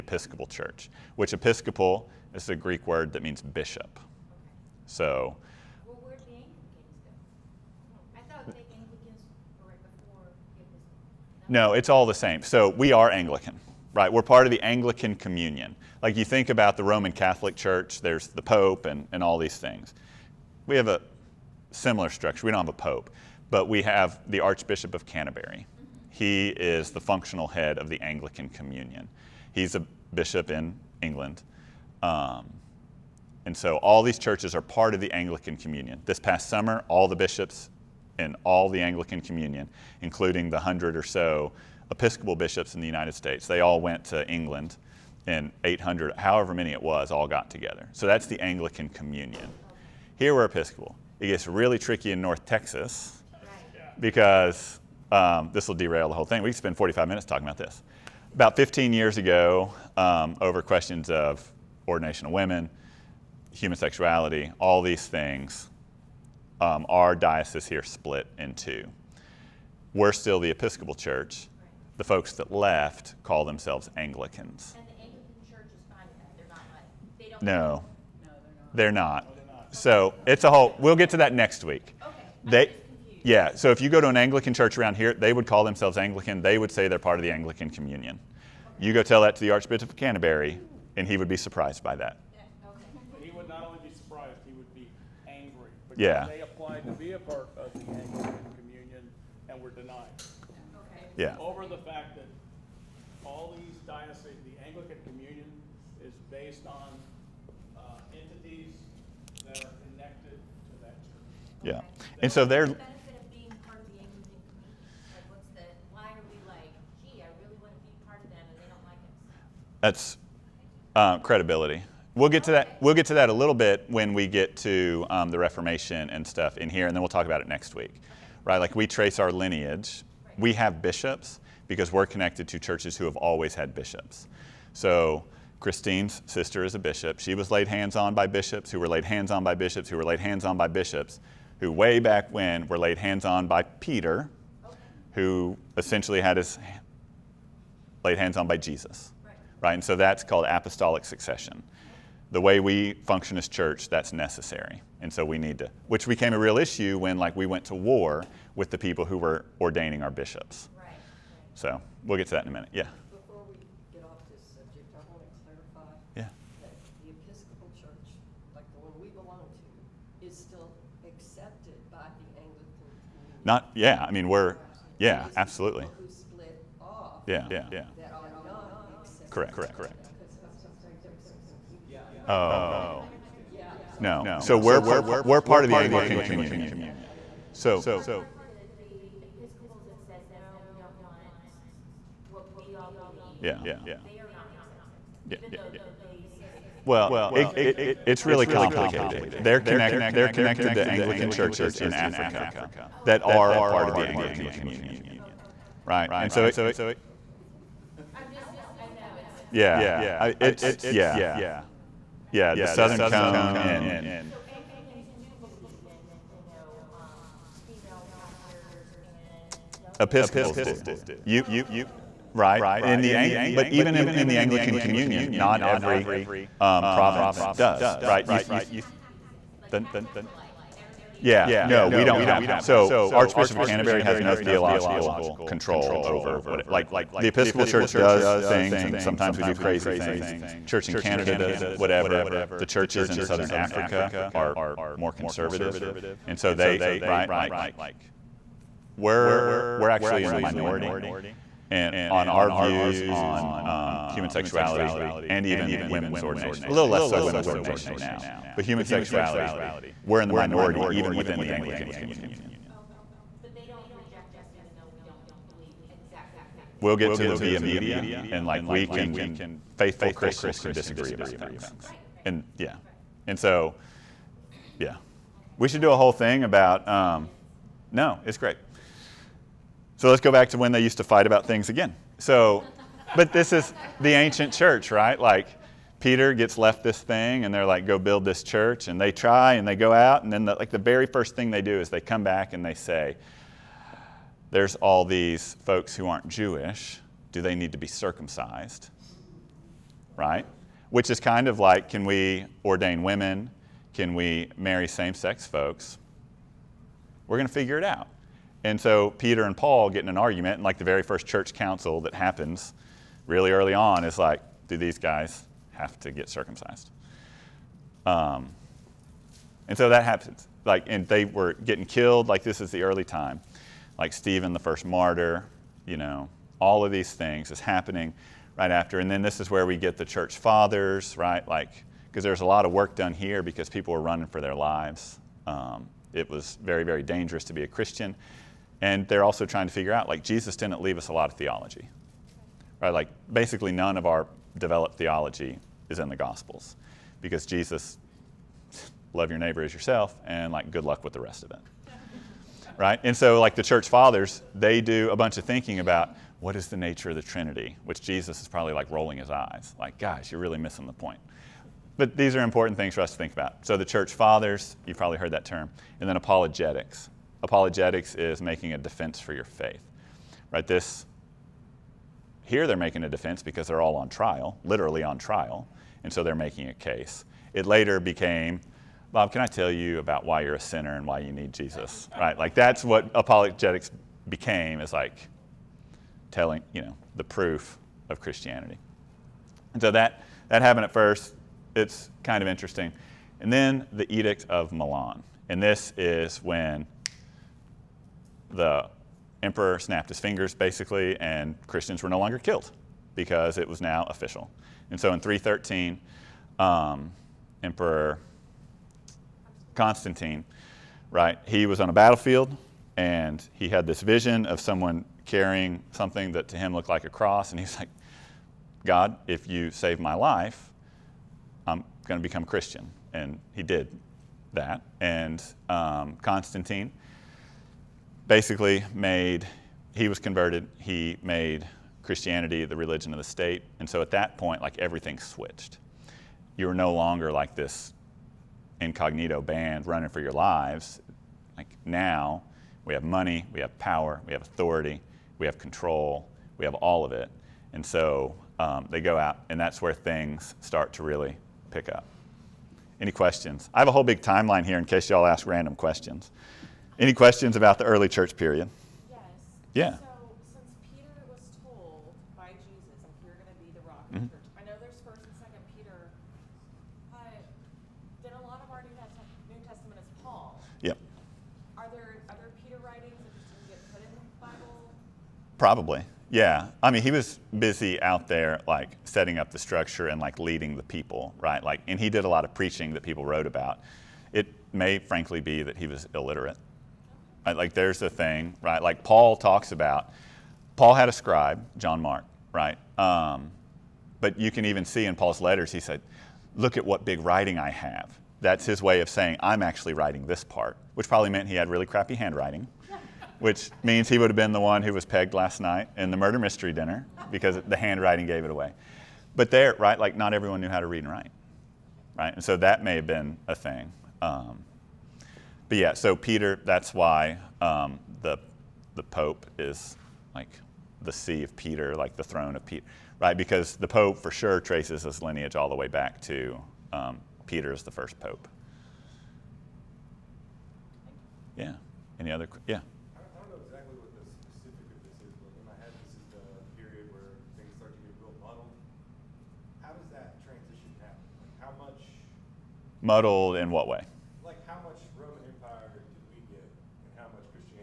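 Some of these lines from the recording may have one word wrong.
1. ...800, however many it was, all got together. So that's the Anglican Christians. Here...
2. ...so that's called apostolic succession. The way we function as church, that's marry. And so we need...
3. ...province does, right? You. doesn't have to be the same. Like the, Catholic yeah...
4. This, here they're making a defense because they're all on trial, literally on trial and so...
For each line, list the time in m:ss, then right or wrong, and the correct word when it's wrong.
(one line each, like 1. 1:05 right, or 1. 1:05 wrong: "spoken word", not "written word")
1. 0:45 wrong: "Communion", not "Christians"
2. 2:29 wrong: "necessary", not "marry"
3. 3:46 right
4. 6:10 right.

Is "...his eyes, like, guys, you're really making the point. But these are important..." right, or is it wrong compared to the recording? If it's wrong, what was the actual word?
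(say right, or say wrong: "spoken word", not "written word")
wrong: "missing", not "making".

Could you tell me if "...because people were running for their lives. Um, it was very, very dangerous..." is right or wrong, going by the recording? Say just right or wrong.
right.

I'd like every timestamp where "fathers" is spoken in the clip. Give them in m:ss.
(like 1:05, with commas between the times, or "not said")
5:30, 5:53, 6:04.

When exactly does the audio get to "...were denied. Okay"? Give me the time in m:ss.
1:39.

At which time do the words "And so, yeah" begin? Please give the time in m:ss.
4:33.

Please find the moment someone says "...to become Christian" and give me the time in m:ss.
7:02.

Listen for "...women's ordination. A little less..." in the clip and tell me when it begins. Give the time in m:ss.
4:15.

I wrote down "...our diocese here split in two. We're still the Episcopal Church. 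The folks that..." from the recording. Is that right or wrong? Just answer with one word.
right.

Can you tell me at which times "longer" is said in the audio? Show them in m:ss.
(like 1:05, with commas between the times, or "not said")
6:42, 7:16.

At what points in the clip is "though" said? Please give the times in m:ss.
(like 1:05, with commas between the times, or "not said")
3:15, 4:24.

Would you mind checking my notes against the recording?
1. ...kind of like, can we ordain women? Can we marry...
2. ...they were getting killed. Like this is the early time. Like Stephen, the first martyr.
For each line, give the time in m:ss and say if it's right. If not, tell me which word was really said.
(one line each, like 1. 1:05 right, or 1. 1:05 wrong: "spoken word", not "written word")
1. 5:01 right
2. 5:21 right.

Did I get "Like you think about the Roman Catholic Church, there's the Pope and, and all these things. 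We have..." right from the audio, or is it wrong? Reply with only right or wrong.
right.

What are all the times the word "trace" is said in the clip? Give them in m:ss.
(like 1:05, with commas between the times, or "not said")
2:08, 8:44.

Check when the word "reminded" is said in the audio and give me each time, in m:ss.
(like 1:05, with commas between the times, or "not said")
not said.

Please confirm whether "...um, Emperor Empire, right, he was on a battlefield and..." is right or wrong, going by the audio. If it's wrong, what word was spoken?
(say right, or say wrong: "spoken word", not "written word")
wrong: "Constantine", not "Empire".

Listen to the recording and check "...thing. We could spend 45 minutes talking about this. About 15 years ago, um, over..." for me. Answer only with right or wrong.
right.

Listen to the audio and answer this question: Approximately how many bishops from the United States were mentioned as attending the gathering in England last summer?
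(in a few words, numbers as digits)
100.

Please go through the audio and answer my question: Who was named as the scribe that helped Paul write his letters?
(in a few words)
John Mark.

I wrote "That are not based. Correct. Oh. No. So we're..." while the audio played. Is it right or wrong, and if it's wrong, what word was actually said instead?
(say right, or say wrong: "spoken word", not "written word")
wrong: "accepted", not "based".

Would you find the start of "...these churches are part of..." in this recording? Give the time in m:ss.
0:34.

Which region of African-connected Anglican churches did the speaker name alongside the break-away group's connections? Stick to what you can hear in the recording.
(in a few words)
The Southern Cone.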